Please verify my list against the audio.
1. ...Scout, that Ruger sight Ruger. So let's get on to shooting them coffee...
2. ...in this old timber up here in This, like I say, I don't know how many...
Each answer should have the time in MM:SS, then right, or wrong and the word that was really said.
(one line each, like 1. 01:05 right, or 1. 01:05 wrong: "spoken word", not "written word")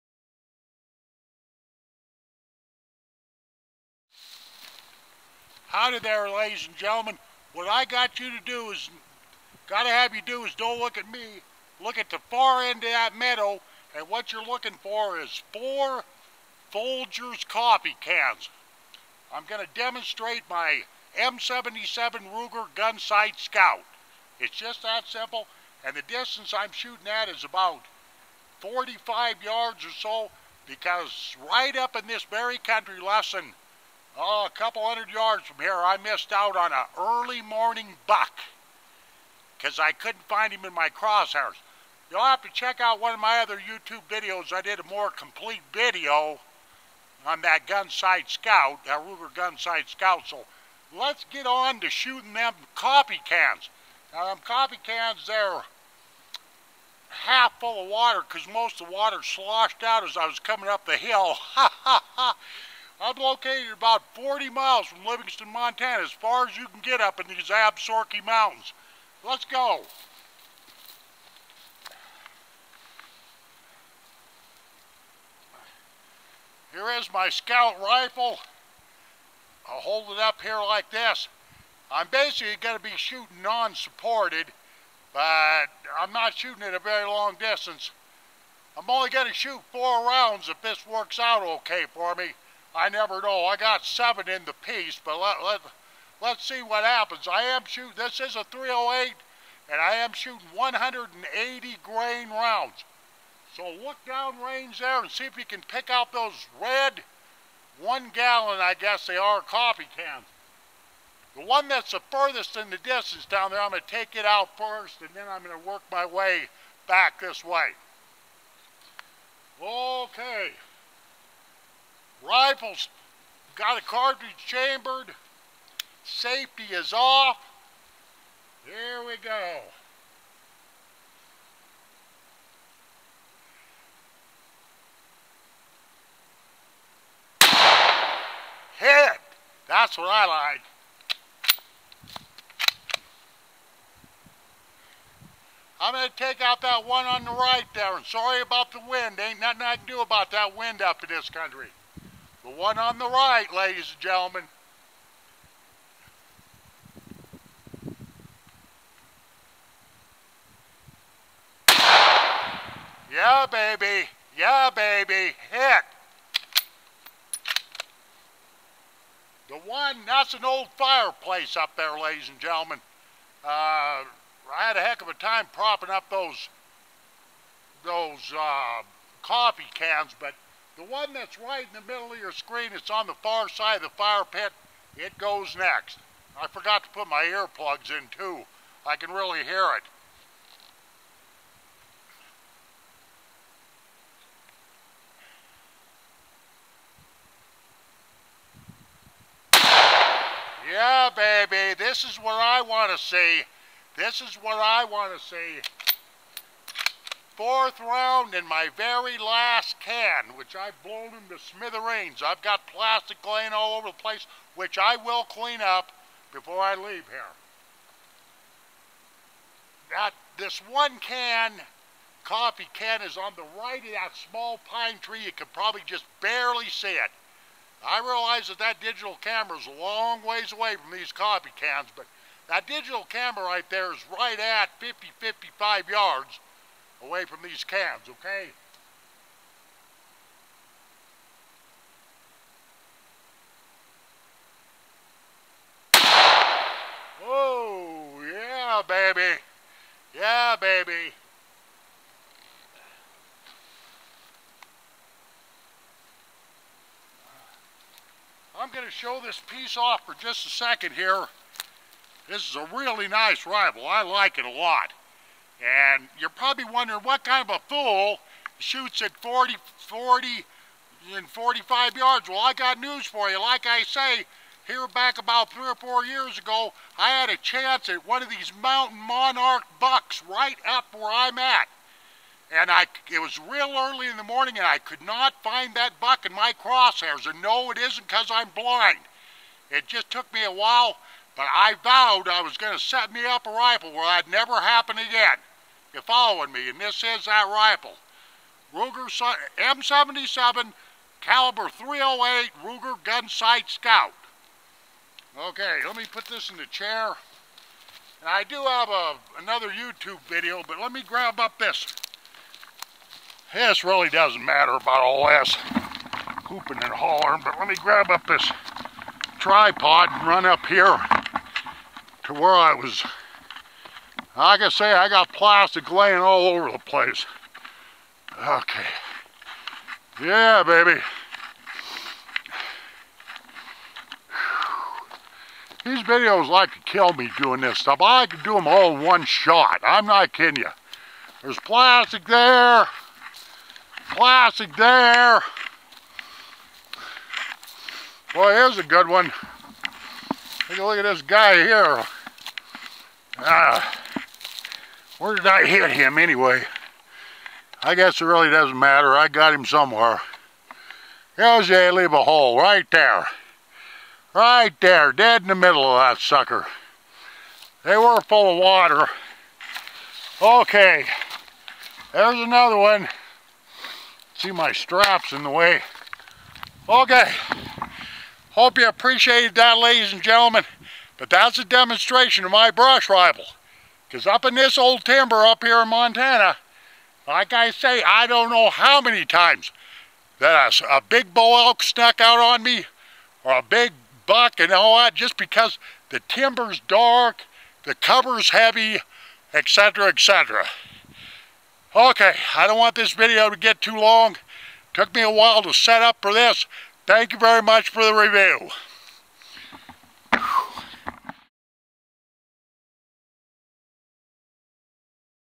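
1. 00:48 wrong: "Scout", not "Ruger"
2. 06:24 wrong: "Montana", not "This".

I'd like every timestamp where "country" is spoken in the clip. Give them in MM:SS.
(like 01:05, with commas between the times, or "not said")
00:32, 02:31.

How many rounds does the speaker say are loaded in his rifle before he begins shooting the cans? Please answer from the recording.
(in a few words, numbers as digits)
7.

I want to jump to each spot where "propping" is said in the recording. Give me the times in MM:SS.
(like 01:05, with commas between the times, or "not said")
02:55.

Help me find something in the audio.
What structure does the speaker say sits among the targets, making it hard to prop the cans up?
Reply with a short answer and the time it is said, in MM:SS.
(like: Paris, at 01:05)
an old fireplace, at 02:50.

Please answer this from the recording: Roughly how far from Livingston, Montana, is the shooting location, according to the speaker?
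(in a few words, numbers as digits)
40 miles.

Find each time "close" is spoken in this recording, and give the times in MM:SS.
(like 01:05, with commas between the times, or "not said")
not said.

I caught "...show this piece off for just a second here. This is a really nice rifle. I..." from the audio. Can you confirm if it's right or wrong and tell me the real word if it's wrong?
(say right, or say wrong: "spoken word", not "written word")
right.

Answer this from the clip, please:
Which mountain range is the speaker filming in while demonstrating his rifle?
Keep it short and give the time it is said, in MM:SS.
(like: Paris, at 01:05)
Absaroka Mountains, at 01:07.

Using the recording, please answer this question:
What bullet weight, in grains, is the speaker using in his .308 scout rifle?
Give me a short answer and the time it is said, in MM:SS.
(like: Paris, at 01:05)
180 grain, at 01:40.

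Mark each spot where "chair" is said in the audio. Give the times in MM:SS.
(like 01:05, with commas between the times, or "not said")
05:06.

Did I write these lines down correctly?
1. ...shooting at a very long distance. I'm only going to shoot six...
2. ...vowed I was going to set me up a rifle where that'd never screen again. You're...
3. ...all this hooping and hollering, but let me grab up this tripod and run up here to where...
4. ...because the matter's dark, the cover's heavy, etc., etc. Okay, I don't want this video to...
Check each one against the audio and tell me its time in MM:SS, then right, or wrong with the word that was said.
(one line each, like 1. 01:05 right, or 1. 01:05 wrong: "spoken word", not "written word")
1. 01:26 wrong: "four", not "six"
2. 04:51 wrong: "happen", not "screen"
3. 05:15 right
4. 06:35 wrong: "timber", not "matter".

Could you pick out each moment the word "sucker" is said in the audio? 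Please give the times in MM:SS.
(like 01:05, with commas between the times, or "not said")
06:06.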